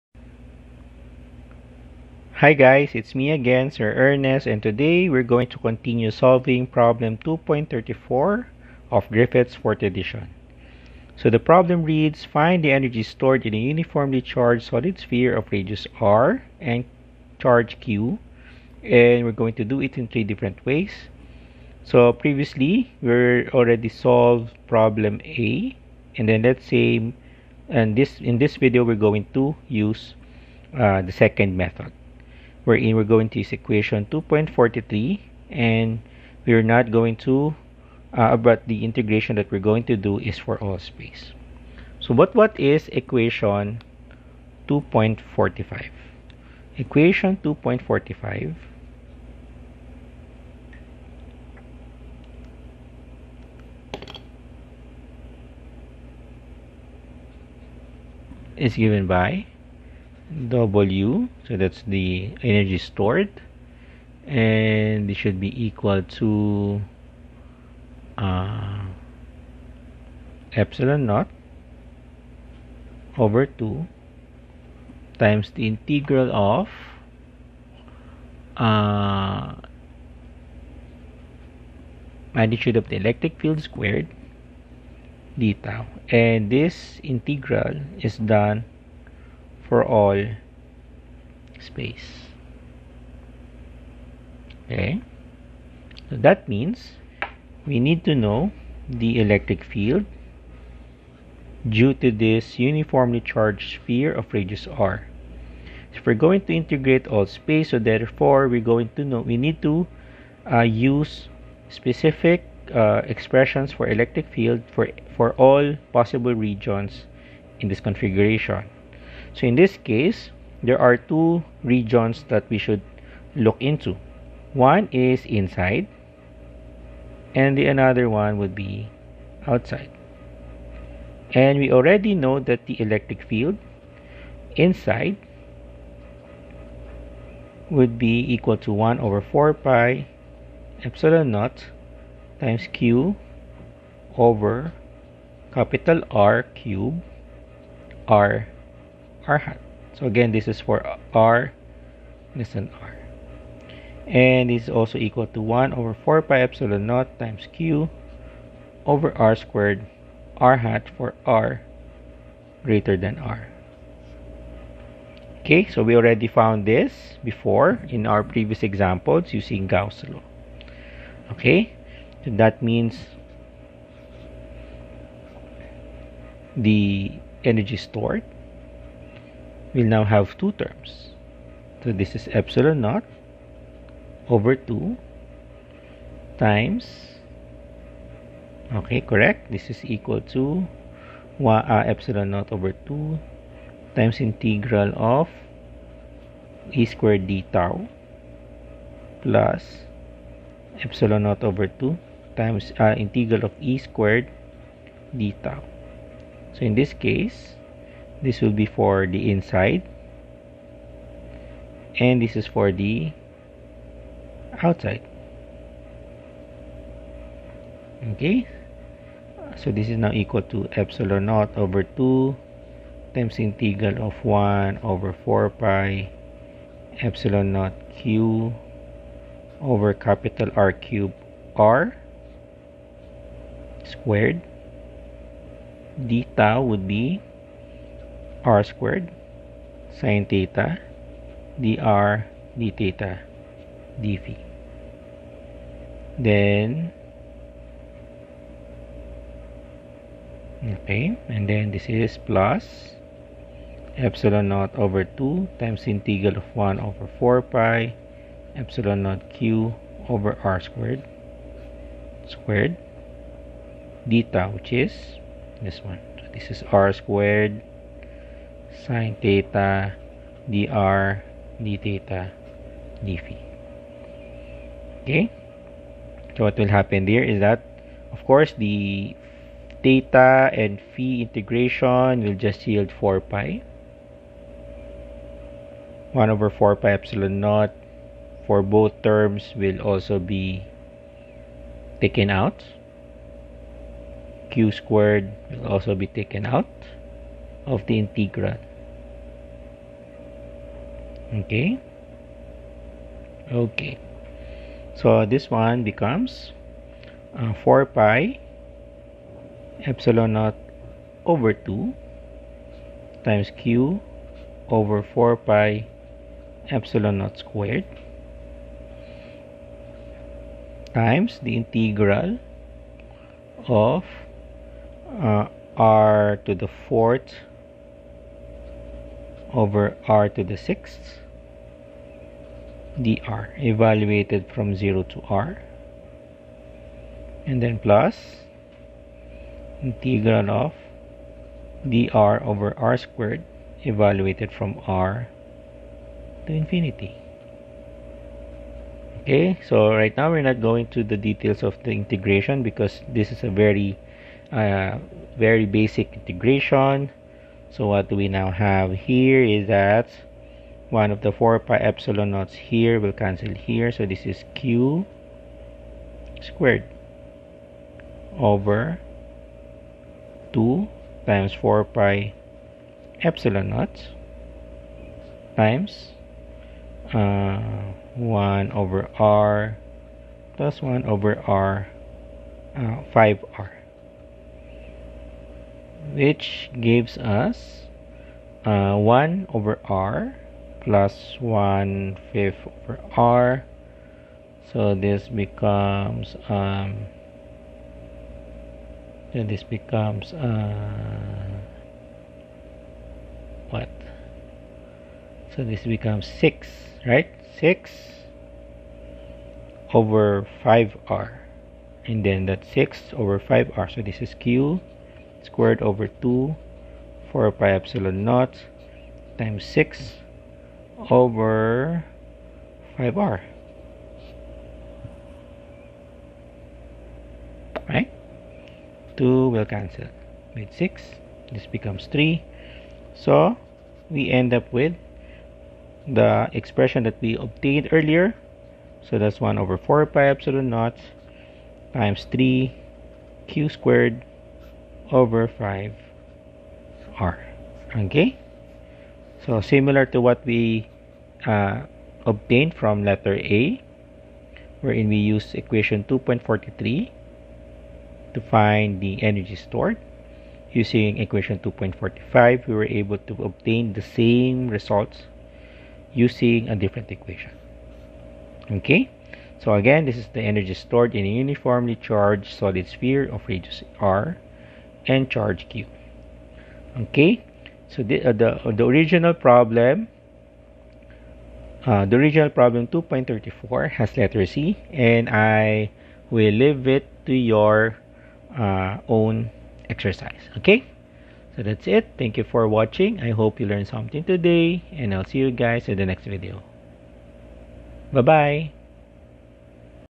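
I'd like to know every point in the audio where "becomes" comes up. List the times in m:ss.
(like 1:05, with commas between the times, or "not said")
5:05, 6:35, 6:39, 6:45, 7:11.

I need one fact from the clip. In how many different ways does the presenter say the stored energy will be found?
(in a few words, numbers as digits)
3.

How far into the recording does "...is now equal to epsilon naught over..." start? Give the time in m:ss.
3:39.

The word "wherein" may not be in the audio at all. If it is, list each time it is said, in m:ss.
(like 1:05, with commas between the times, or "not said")
0:32, 7:34.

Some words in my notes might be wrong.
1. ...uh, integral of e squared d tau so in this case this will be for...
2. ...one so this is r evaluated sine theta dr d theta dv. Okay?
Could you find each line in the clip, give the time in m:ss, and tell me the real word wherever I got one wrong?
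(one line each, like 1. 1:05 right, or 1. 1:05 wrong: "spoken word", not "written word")
1. 3:22 right
2. 4:25 wrong: "squared", not "evaluated".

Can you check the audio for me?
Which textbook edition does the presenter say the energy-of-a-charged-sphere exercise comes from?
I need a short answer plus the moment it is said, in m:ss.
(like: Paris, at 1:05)
fourth edition, at 0:09.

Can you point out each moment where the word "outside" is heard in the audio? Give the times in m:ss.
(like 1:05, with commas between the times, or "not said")
2:09, 3:34.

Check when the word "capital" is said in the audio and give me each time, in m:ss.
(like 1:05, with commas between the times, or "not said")
2:25, 3:49.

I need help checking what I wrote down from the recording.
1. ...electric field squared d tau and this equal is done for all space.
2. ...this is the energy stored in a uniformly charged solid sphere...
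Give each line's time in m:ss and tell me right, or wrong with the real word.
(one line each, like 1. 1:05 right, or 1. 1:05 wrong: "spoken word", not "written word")
1. 1:22 wrong: "integral", not "equal"
2. 7:50 right.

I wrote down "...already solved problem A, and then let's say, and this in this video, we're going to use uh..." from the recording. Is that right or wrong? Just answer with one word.
right.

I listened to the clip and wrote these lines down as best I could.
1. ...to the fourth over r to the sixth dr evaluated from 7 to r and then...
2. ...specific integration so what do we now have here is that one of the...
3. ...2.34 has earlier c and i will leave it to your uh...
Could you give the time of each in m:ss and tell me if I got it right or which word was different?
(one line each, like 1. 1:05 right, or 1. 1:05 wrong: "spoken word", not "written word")
1. 5:26 wrong: "0", not "7"
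2. 5:55 wrong: "basic", not "specific"
3. 8:02 wrong: "letter", not "earlier".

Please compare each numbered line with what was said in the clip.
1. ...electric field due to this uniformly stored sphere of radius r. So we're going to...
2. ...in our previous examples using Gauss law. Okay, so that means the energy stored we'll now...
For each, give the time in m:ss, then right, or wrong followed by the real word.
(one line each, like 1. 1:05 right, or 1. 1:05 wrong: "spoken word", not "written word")
1. 1:39 wrong: "charged", not "stored"
2. 2:47 right.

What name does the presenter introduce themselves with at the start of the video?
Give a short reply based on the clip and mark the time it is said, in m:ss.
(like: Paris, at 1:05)
Sir Ernest, at 0:03.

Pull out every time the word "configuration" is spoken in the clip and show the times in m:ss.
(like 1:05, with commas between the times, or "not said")
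1:57.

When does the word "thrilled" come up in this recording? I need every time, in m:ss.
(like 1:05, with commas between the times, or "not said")
not said.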